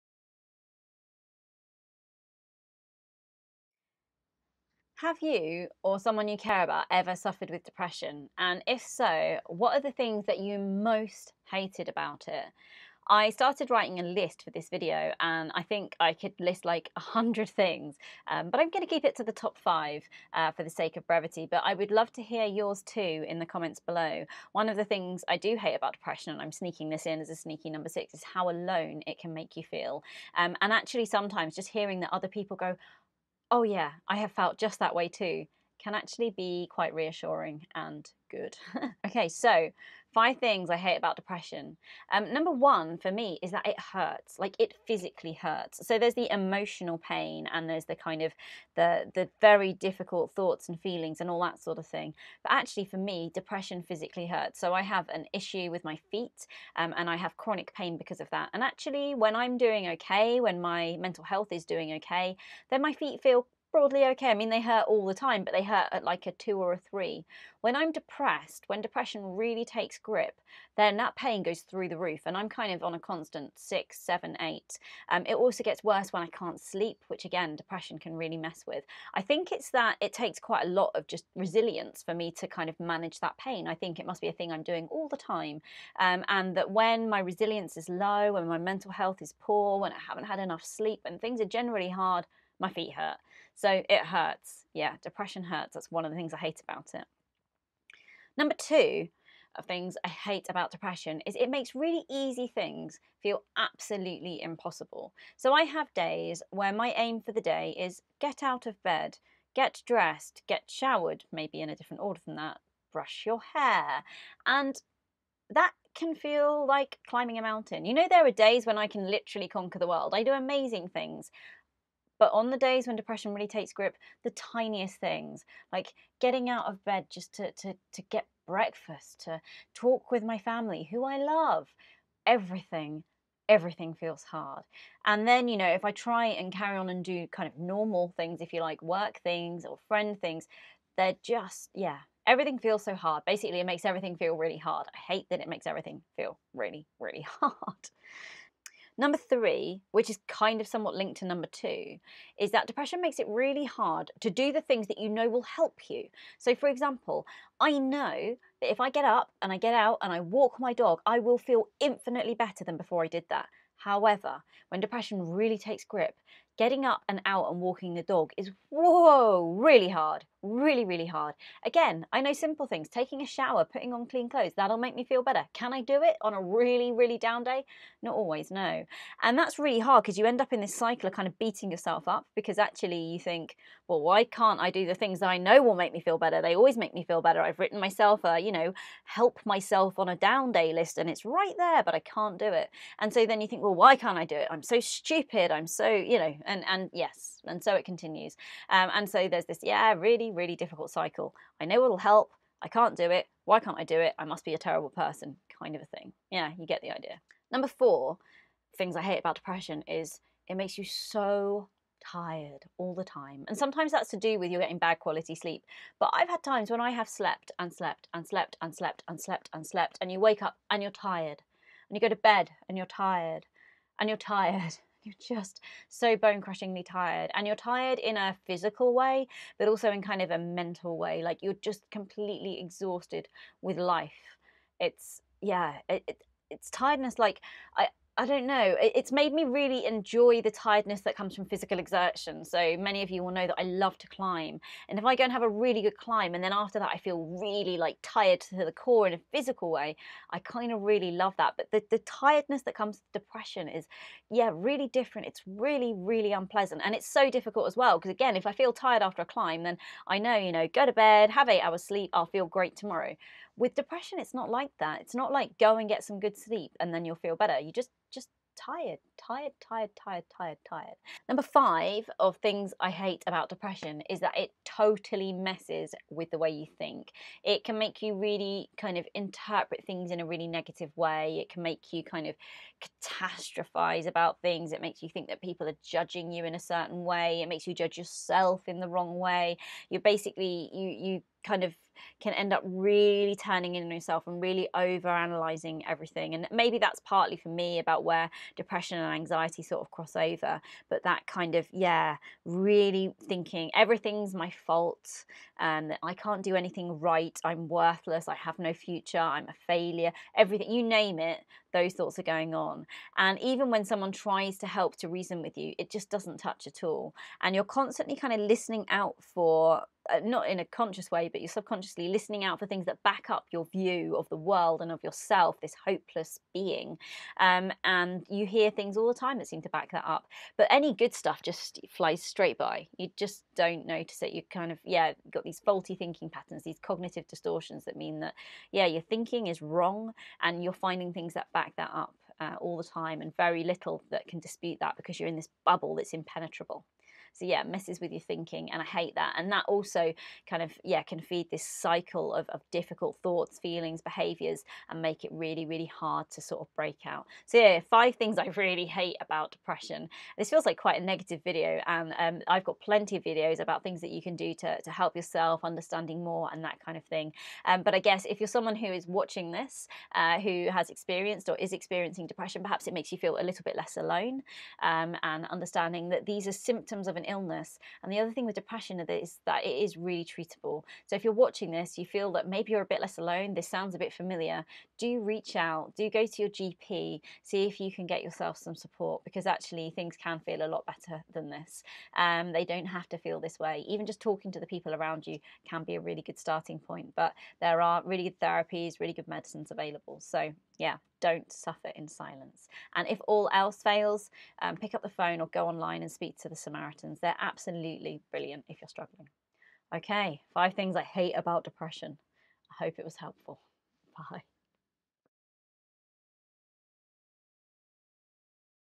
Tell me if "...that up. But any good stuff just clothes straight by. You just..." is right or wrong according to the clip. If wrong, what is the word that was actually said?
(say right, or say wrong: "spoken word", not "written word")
wrong: "flies", not "clothes".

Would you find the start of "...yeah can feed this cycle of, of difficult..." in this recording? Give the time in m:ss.
5:50.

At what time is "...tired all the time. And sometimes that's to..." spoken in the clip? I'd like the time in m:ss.
3:32.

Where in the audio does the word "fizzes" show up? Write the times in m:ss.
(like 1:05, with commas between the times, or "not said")
not said.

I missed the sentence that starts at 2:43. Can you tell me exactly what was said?
However, when depression really takes grip, getting up and out and walking the dog is whoa, really hard, really, really hard.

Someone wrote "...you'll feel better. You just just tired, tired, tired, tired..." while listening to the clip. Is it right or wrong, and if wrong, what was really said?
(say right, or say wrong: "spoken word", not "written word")
right.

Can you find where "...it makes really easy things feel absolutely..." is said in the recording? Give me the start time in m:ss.
1:41.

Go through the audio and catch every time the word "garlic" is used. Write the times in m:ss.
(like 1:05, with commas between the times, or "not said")
not said.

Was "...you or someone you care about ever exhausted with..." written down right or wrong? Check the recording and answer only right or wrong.
wrong.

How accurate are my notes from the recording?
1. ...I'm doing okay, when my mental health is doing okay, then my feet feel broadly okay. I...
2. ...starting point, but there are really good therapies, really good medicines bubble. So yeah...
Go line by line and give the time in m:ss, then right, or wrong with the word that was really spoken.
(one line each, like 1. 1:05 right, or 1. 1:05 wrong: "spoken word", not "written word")
1. 0:59 right
2. 6:36 wrong: "available", not "bubble".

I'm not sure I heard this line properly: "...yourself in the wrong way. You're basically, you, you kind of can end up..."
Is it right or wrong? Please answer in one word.
right.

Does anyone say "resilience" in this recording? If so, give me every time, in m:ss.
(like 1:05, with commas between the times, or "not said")
1:21, 1:27.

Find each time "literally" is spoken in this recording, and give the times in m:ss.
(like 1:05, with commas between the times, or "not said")
1:59.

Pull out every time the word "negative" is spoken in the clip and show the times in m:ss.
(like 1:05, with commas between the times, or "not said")
4:40, 6:01.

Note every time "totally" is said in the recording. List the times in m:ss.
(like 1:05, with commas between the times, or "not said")
4:34.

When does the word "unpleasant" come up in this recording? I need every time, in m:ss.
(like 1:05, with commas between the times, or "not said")
4:16.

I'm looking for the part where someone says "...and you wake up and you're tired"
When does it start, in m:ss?
3:40.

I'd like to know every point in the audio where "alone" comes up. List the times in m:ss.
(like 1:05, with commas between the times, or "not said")
0:28, 6:13, 6:23.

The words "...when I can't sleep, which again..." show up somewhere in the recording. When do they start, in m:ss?
1:16.